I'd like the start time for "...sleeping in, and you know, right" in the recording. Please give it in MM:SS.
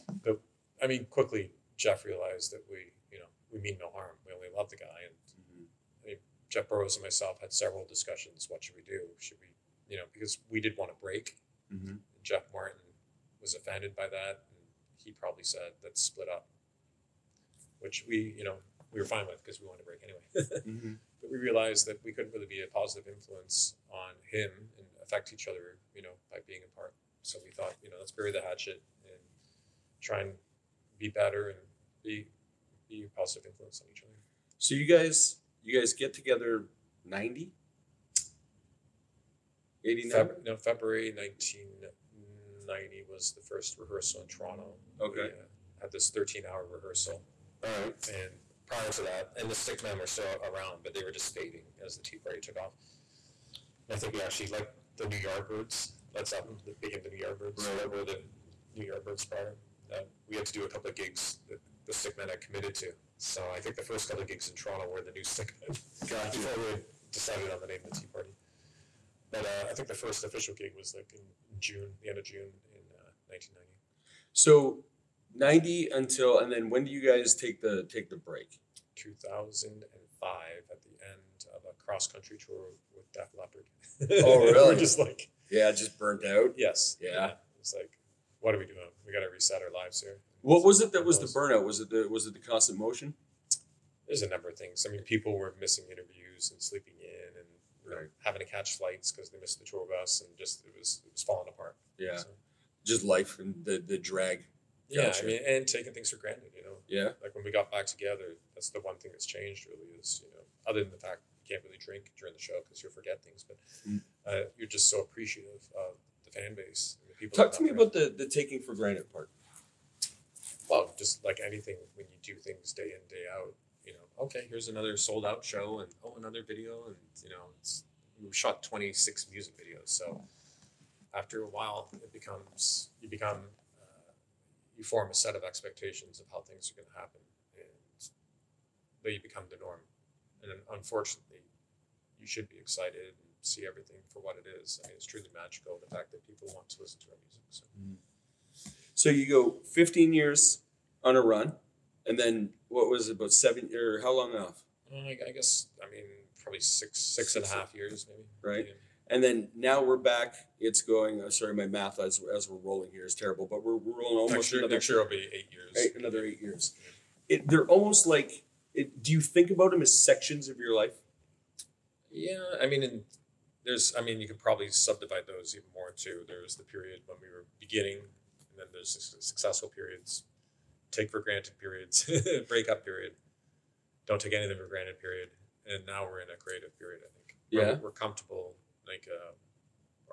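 01:36.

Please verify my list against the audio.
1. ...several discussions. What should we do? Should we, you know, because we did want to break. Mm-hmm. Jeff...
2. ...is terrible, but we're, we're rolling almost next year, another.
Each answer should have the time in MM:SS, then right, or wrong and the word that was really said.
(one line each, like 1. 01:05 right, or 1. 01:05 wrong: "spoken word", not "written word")
1. 00:07 right
2. 02:43 right.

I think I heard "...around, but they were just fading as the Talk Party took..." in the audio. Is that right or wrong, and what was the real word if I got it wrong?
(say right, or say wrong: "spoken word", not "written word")
wrong: "Tea", not "Talk".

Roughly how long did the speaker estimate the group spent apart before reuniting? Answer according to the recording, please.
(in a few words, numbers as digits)
six and a half years.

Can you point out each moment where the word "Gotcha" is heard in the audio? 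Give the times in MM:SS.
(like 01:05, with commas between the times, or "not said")
01:06, 01:44.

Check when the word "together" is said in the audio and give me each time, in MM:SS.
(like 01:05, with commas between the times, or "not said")
00:36, 01:47.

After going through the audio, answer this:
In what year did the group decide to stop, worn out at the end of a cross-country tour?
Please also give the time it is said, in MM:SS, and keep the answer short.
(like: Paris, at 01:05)
2005, at 01:18.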